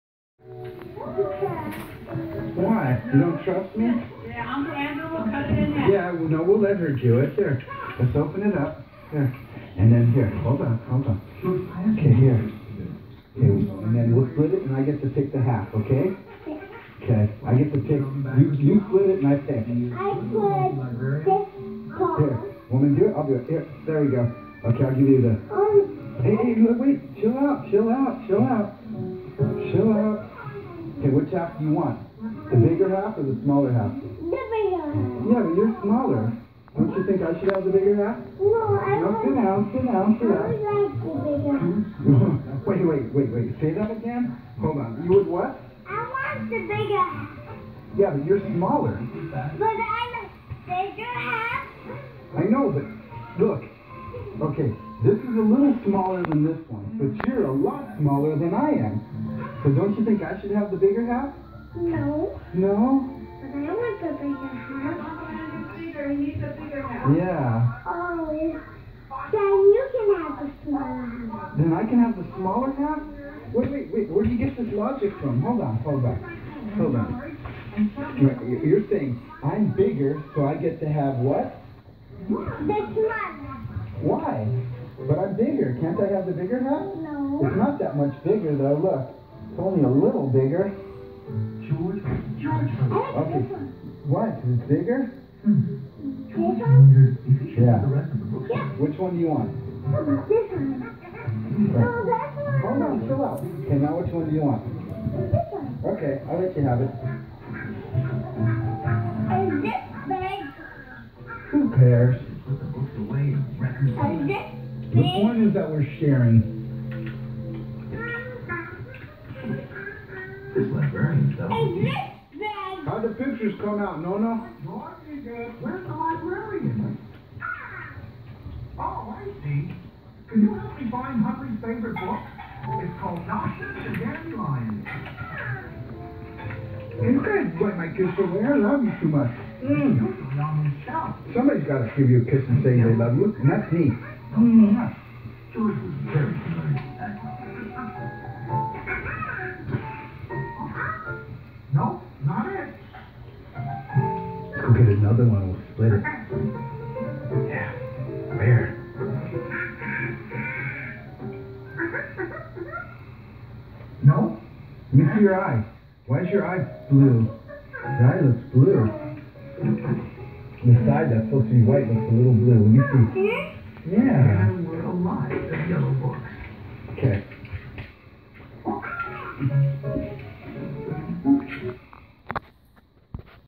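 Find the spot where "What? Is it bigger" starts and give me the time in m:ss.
1:34.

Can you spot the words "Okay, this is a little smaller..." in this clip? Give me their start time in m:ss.
0:54.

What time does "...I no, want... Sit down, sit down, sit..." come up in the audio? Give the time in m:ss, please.
0:38.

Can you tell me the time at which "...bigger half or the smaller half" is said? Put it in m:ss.
0:32.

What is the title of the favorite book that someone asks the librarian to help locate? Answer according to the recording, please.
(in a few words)
Nonsense and Dandelions.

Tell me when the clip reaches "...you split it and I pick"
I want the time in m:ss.
0:18.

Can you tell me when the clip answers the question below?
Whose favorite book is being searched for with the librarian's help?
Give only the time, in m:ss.
2:11.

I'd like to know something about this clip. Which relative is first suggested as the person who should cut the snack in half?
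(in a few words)
Uncle Andrew.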